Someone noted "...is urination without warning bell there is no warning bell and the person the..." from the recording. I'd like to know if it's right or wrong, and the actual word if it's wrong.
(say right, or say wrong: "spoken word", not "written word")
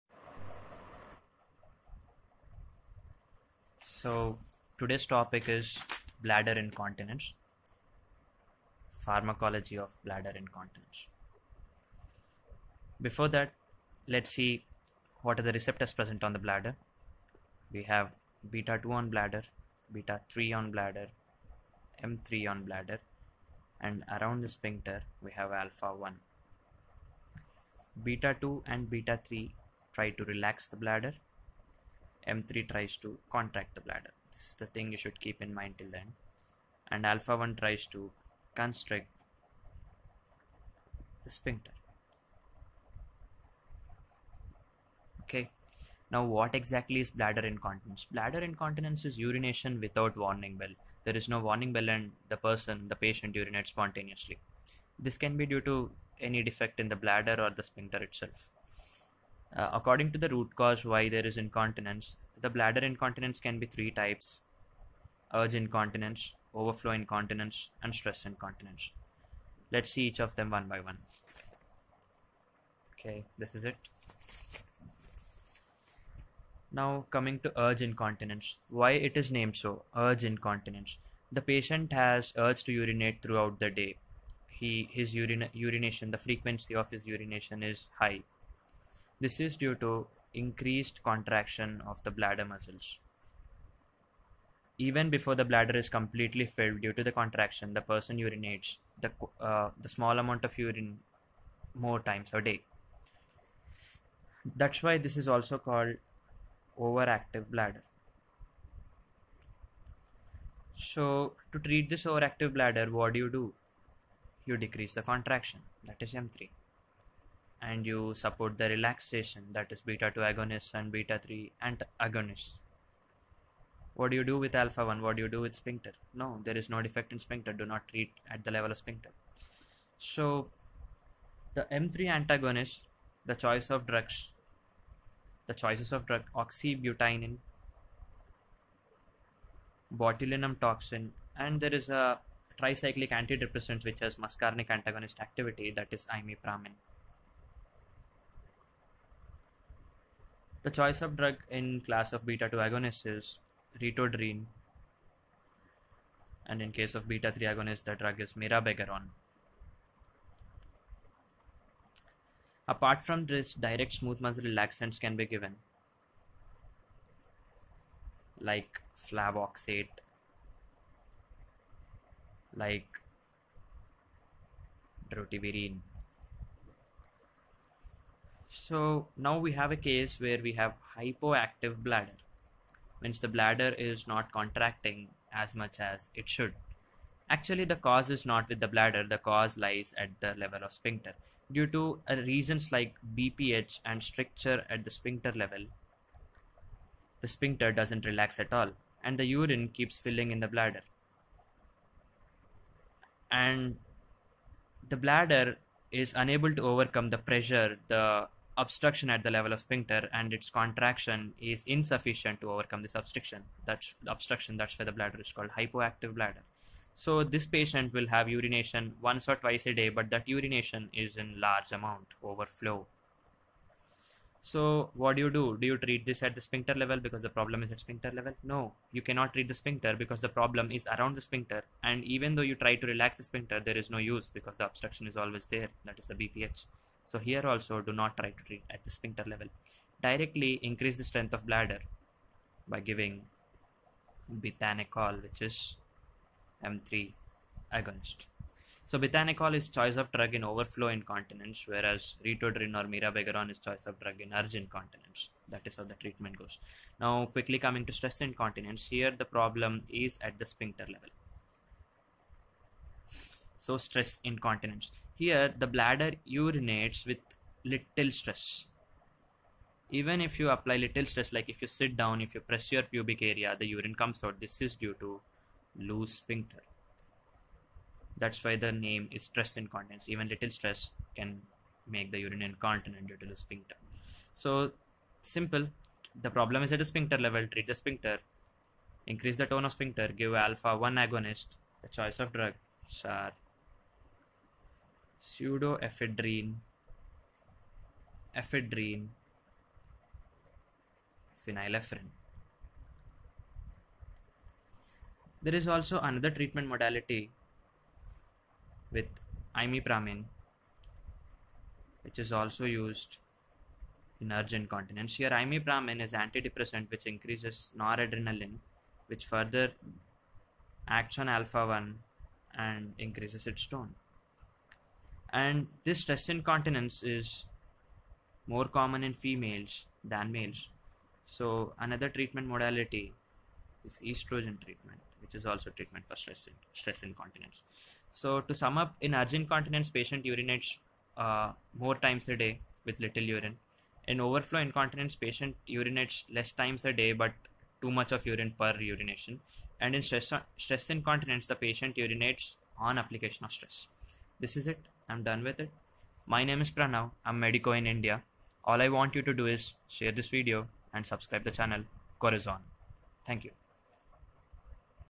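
right.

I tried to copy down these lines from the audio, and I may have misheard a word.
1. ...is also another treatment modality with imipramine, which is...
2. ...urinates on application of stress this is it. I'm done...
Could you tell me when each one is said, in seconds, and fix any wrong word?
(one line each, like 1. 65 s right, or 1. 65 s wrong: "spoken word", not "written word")
1. 305 s right
2. 351 s right.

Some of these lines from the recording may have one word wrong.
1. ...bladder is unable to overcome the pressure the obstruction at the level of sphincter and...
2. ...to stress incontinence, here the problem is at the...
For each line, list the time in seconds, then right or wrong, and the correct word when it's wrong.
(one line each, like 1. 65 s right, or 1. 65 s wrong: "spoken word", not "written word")
1. 204 s right
2. 257 s right.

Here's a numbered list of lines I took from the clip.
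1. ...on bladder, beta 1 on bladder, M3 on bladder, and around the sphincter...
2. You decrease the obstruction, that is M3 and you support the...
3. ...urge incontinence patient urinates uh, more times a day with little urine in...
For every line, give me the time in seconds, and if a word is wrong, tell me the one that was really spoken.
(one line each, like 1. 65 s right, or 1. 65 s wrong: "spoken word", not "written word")
1. 18 s wrong: "3", not "1"
2. 114 s wrong: "contraction", not "obstruction"
3. 339 s right.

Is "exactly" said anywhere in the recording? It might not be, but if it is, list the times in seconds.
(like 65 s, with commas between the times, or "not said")
46 s.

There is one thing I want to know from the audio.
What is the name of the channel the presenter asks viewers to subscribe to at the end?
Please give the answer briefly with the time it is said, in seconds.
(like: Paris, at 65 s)
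Corazon, at 362 s.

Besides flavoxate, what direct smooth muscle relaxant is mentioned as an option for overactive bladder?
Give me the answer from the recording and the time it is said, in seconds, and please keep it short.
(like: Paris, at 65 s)
Drotaverine, at 175 s.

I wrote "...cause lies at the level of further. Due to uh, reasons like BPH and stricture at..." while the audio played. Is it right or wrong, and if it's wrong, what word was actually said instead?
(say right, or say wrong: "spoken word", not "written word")
wrong: "sphincter", not "further".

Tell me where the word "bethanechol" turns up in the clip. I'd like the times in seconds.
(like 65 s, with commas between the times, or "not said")
244 s, 248 s.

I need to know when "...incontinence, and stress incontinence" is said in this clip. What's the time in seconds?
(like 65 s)
66 s.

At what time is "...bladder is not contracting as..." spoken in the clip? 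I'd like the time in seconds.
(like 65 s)
183 s.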